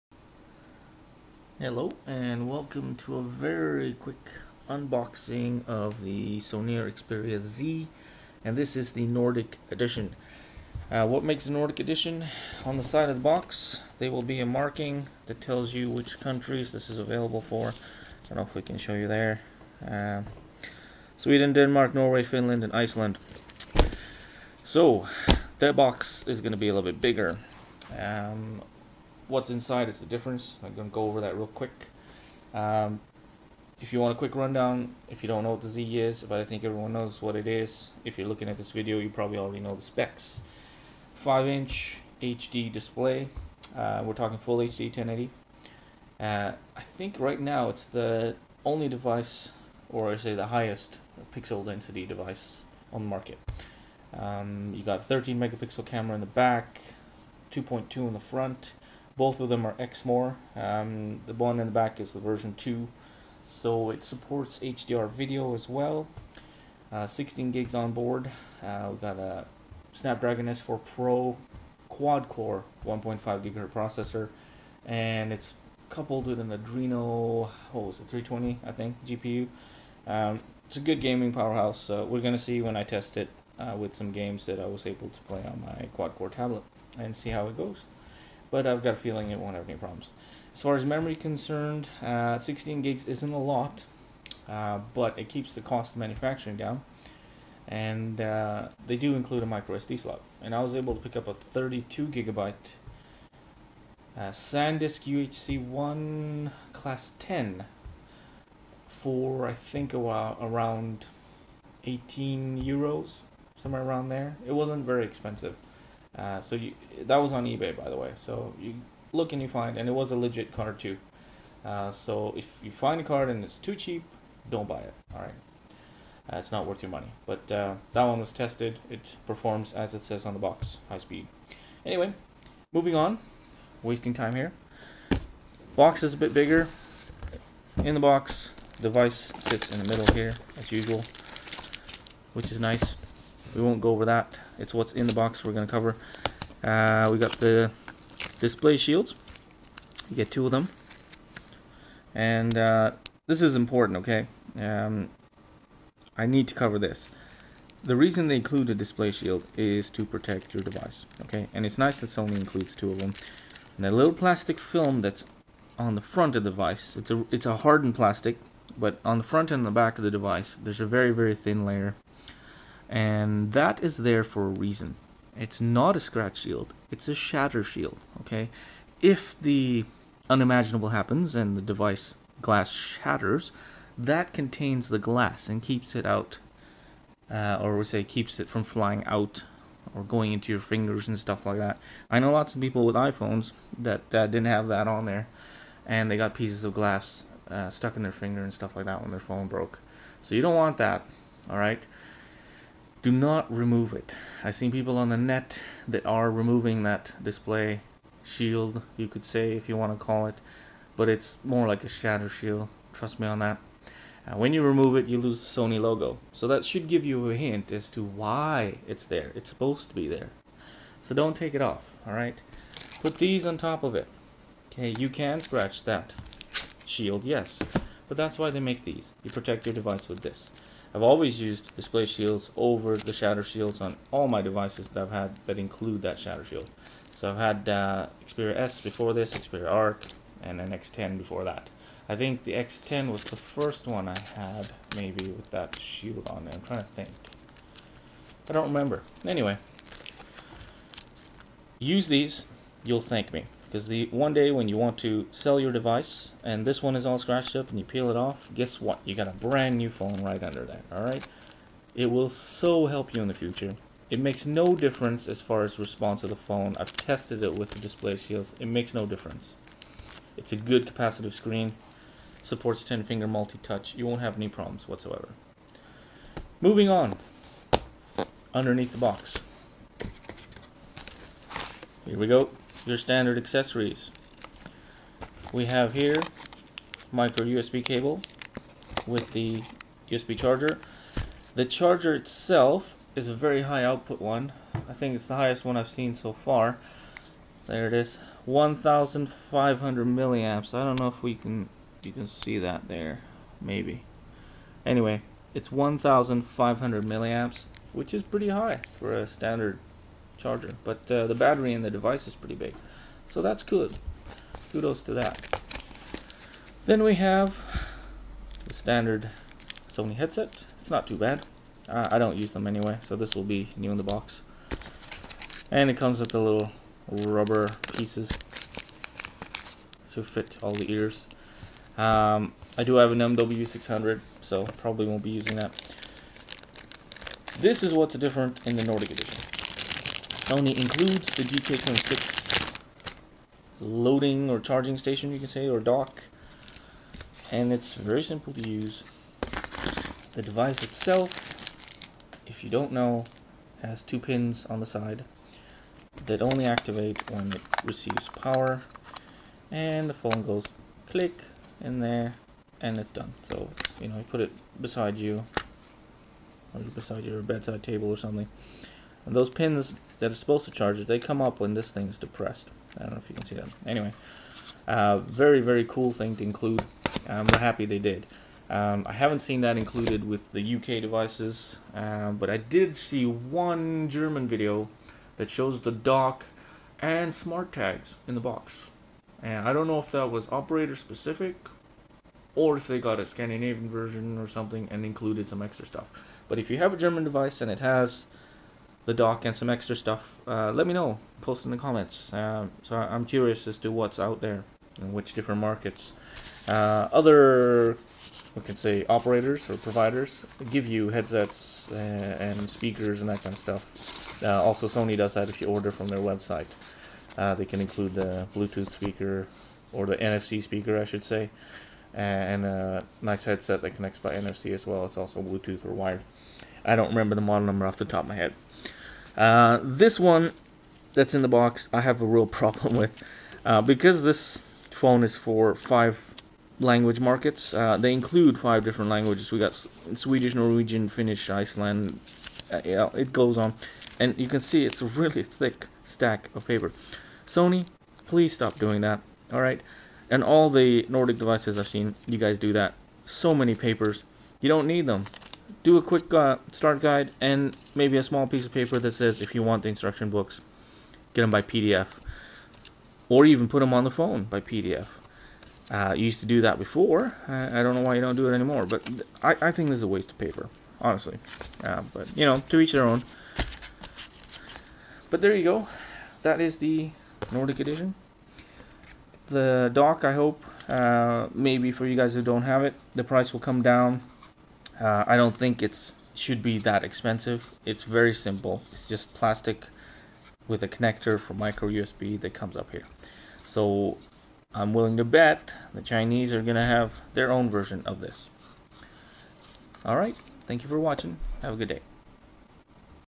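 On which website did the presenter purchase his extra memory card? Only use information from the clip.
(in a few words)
eBay.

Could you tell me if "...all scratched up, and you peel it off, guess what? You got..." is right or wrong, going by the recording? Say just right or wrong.
right.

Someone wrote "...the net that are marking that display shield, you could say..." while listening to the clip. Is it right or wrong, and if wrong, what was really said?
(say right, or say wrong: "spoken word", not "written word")
wrong: "removing", not "marking".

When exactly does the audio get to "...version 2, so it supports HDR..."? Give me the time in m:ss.
1:02.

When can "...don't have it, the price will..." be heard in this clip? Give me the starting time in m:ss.
8:02.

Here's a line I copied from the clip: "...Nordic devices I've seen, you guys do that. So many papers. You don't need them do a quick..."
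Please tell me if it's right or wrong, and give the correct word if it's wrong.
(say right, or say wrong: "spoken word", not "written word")
right.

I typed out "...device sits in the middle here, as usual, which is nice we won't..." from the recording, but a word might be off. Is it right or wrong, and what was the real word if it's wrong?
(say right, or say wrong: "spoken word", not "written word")
right.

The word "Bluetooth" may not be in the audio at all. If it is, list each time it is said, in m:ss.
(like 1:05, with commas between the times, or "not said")
6:58, 7:05.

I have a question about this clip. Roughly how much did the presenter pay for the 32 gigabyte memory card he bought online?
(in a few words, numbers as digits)
18 euros.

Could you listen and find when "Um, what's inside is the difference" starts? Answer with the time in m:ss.
0:27.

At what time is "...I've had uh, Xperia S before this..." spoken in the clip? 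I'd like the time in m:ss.
3:57.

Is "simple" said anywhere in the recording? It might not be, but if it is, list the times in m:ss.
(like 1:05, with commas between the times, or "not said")
5:48, 8:08.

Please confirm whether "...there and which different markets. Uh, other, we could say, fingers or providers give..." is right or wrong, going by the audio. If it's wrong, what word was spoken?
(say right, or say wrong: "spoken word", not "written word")
wrong: "operators", not "fingers".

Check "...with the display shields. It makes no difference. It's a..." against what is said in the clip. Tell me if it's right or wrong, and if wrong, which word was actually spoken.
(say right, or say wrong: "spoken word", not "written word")
right.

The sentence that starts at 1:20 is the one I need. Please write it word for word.
Um, it's a good gaming powerhouse.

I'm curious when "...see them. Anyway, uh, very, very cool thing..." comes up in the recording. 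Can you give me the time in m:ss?
6:13.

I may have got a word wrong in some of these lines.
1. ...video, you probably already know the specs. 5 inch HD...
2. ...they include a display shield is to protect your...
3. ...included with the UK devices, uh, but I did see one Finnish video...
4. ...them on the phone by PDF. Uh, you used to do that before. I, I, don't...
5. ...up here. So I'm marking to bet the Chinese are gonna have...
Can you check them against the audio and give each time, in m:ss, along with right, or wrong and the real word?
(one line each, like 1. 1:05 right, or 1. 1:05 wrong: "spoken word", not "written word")
1. 0:38 right
2. 2:38 right
3. 6:19 wrong: "German", not "Finnish"
4. 7:43 right
5. 8:12 wrong: "willing", not "marking".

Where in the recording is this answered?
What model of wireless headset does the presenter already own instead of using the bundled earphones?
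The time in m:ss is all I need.
5:33.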